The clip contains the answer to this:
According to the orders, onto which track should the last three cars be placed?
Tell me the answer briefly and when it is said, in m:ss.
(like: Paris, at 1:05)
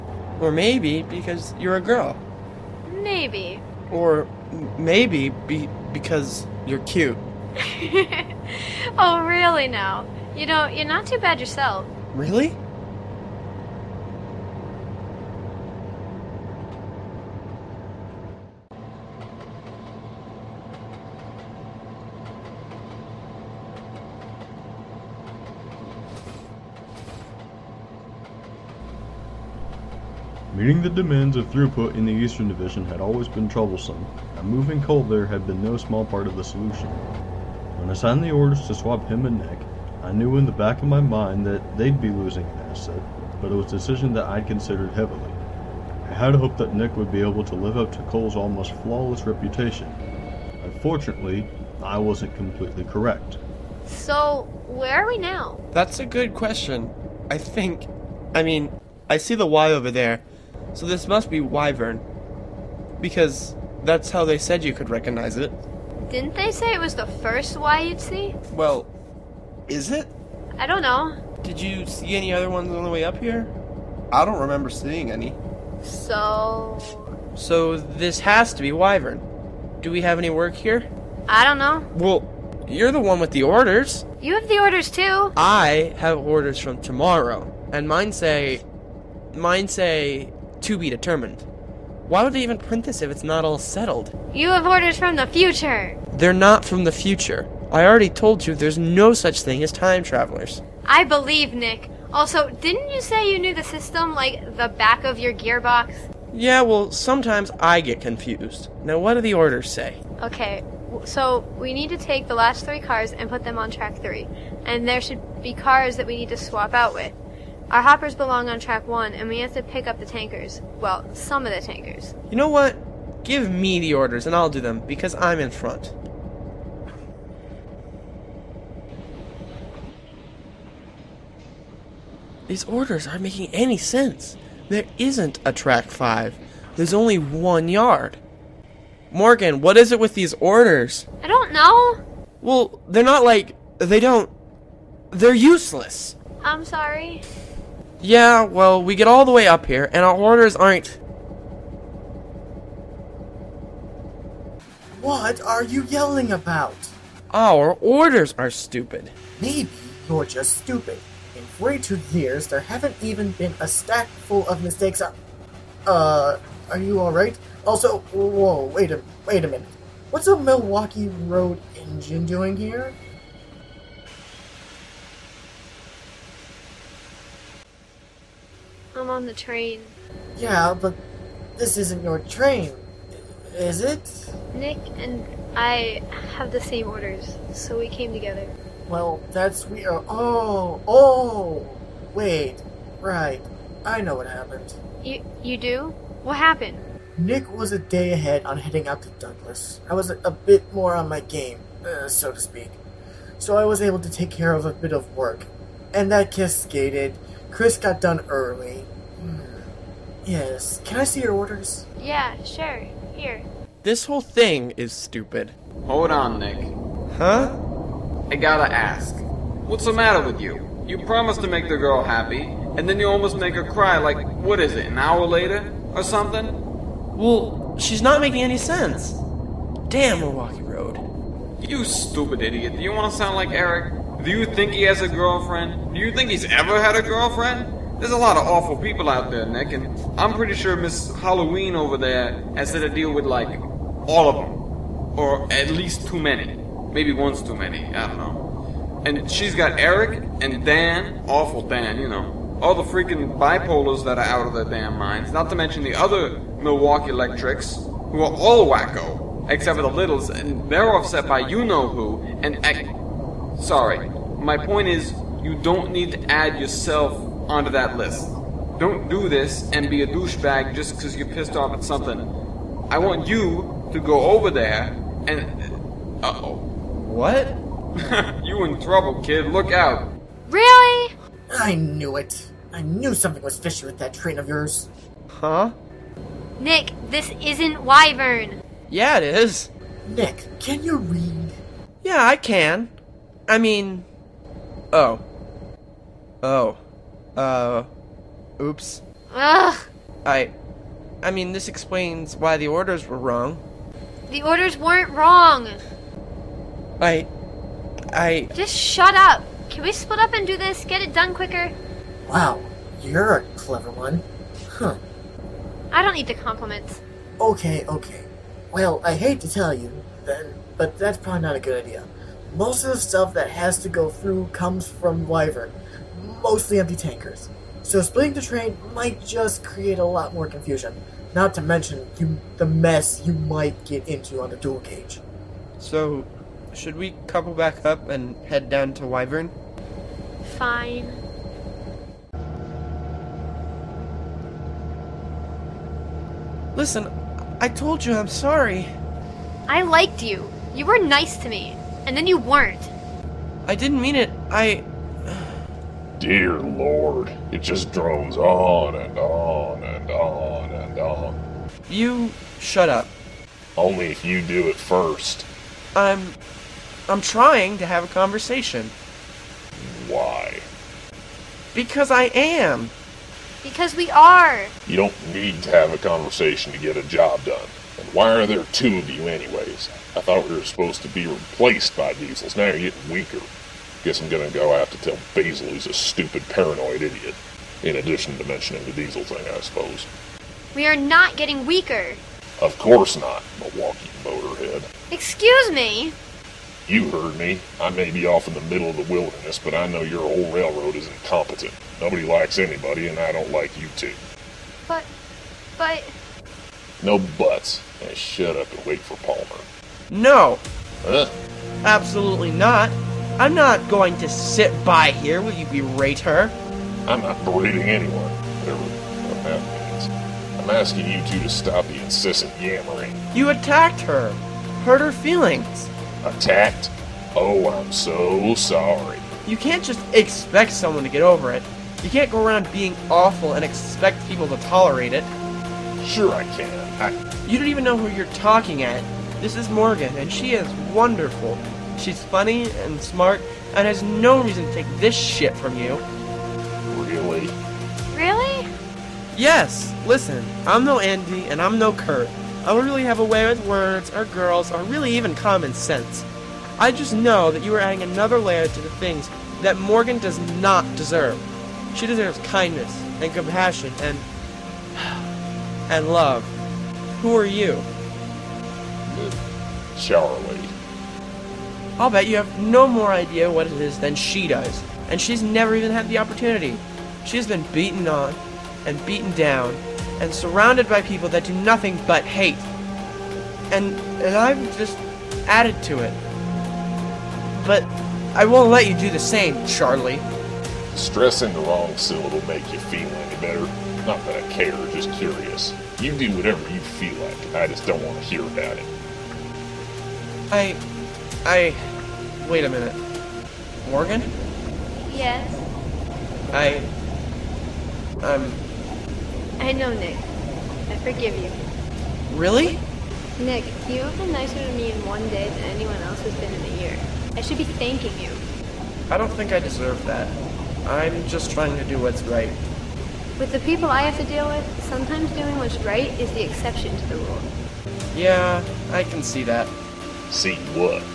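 track 3, at 1:53.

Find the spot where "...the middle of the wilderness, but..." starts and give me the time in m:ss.
6:38.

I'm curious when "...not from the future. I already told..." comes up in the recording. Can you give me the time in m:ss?
1:36.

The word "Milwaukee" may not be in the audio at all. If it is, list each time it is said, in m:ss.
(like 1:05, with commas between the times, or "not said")
2:50, 3:50, 4:16, 6:33.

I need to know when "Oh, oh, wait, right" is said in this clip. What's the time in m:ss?
3:10.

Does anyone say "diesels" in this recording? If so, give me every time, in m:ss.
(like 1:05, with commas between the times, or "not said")
6:22, 6:28.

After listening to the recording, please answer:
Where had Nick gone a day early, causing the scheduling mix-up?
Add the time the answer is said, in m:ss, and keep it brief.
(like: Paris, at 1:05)
Douglas, at 3:19.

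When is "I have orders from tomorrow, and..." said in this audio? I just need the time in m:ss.
1:25.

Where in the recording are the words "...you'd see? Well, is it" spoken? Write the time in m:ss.
1:07.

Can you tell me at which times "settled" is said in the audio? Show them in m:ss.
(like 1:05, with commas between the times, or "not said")
1:33.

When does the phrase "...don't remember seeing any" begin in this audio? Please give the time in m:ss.
1:14.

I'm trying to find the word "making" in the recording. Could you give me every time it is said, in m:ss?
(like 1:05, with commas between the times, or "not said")
2:13, 3:48.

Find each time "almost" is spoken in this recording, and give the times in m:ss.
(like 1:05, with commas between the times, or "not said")
0:48, 3:43.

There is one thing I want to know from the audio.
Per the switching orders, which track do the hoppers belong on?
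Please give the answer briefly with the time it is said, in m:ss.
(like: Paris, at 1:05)
track 1, at 1:58.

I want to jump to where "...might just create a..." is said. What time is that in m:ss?
5:28.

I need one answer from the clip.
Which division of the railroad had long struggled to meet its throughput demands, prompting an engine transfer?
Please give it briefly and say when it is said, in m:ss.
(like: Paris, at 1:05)
Eastern Division, at 0:32.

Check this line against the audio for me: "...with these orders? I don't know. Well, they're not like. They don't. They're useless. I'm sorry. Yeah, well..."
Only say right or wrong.
right.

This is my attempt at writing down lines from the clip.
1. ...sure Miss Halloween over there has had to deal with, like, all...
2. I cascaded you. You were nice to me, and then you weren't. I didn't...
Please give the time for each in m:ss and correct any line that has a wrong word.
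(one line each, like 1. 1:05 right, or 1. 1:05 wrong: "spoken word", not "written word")
1. 4:00 right
2. 5:49 wrong: "liked", not "cascaded".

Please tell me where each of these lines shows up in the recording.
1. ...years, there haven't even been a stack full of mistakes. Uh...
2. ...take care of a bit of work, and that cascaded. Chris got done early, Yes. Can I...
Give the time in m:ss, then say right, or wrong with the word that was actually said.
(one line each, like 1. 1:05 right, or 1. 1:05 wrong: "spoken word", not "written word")
1. 2:42 right
2. 3:24 right.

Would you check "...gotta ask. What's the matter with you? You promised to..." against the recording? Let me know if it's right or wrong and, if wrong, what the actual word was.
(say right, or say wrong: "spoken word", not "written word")
right.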